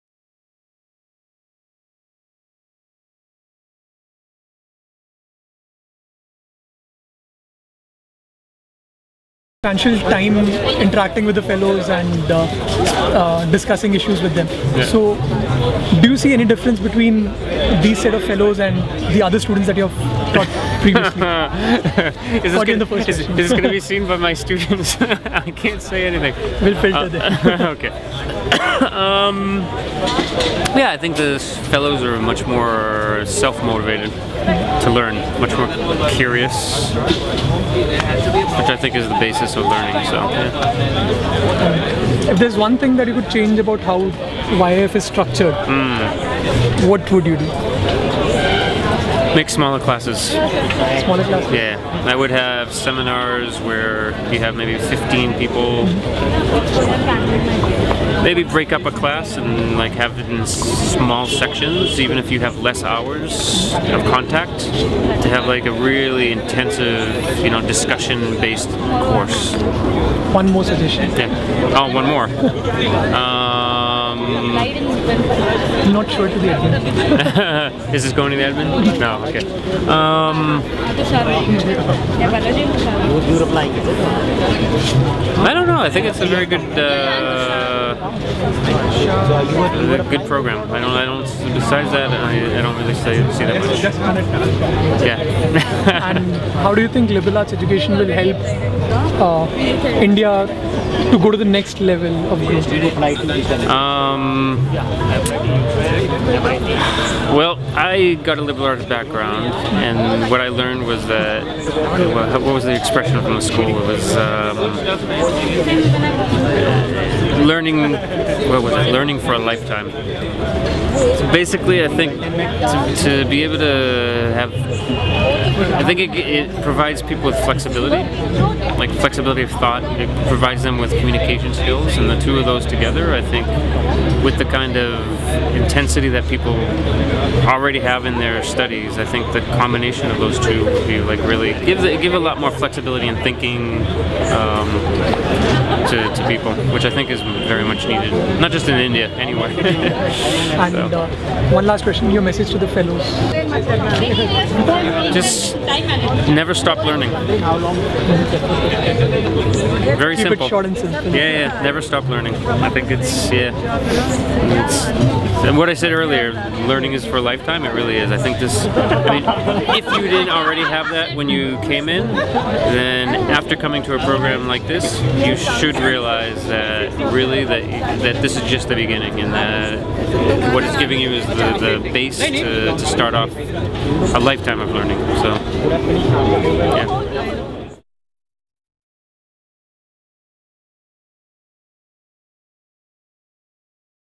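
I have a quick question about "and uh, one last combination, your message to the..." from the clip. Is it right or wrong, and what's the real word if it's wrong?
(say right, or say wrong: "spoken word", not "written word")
wrong: "question", not "combination".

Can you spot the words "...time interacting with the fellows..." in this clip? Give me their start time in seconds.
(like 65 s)
10 s.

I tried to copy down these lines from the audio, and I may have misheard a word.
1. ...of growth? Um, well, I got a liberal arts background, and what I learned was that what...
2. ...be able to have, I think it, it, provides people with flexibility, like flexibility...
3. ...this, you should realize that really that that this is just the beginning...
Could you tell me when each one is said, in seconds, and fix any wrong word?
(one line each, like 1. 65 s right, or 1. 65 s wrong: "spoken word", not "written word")
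1. 102 s right
2. 123 s right
3. 174 s right.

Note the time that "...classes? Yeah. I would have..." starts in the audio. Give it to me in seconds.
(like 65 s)
51 s.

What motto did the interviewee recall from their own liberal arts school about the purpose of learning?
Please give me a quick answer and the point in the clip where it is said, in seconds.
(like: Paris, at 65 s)
Learning for a lifetime, at 118 s.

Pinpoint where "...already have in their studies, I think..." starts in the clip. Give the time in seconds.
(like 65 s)
137 s.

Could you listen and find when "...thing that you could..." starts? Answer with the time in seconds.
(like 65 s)
42 s.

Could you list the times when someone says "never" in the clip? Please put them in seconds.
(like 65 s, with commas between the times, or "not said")
156 s, 161 s.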